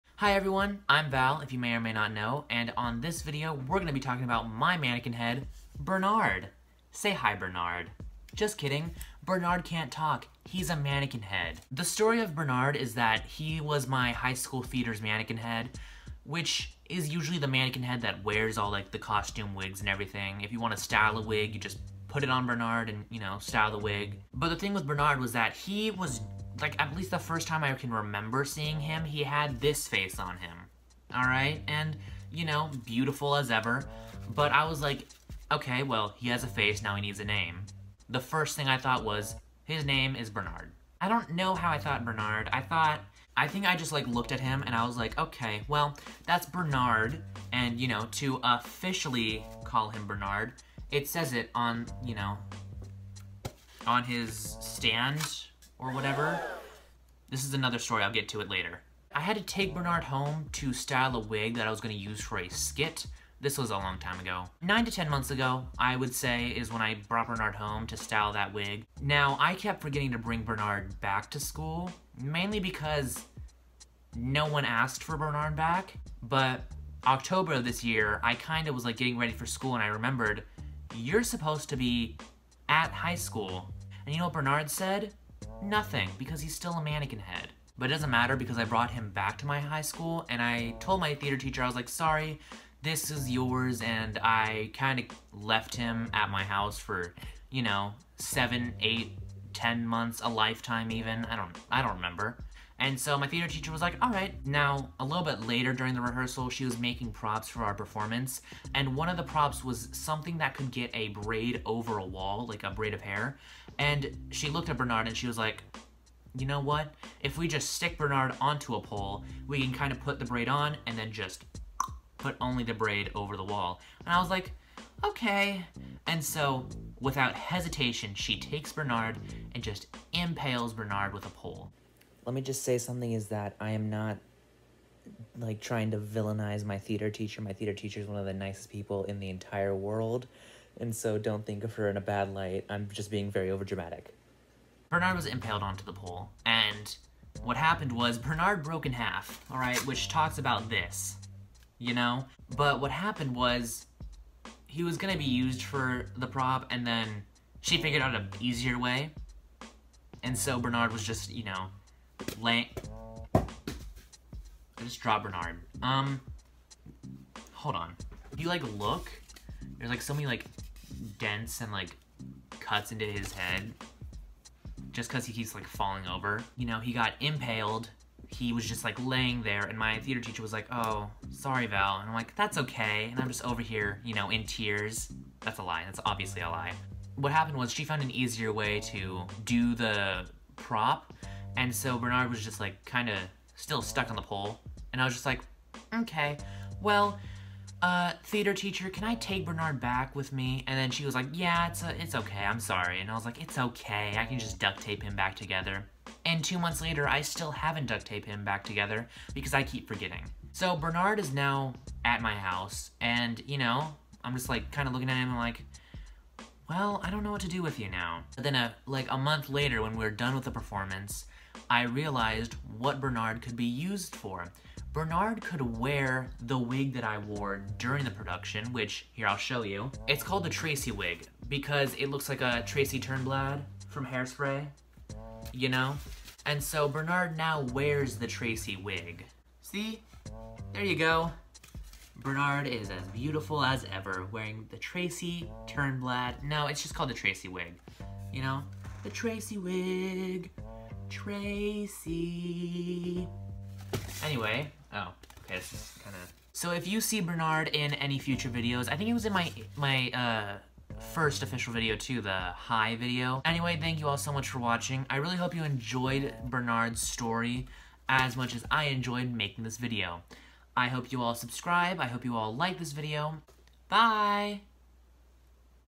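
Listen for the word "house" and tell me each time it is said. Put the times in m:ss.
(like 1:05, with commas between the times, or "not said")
1:36, 3:32.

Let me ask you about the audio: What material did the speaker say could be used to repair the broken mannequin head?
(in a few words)
Duct tape.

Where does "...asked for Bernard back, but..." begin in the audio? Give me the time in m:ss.
1:14.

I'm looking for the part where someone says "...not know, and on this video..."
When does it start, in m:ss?
0:01.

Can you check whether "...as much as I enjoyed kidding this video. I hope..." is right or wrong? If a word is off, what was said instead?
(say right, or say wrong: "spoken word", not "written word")
wrong: "making", not "kidding".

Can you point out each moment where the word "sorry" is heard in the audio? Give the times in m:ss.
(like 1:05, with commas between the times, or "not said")
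1:31, 3:01, 3:22.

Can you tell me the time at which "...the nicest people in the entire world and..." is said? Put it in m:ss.
2:18.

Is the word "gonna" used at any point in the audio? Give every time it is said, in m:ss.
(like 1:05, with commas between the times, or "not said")
0:03, 1:01, 2:34.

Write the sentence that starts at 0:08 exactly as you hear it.
Just kidding, Bernard can't talk, he's a mannequin head.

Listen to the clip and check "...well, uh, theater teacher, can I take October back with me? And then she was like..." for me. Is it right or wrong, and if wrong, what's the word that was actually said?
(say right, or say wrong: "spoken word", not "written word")
wrong: "Bernard", not "October".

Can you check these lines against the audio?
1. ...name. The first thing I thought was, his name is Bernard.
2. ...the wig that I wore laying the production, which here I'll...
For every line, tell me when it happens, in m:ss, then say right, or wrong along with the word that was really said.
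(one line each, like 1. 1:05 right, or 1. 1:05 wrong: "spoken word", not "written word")
1. 0:37 right
2. 3:46 wrong: "during", not "laying".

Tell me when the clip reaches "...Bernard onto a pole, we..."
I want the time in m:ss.
1:57.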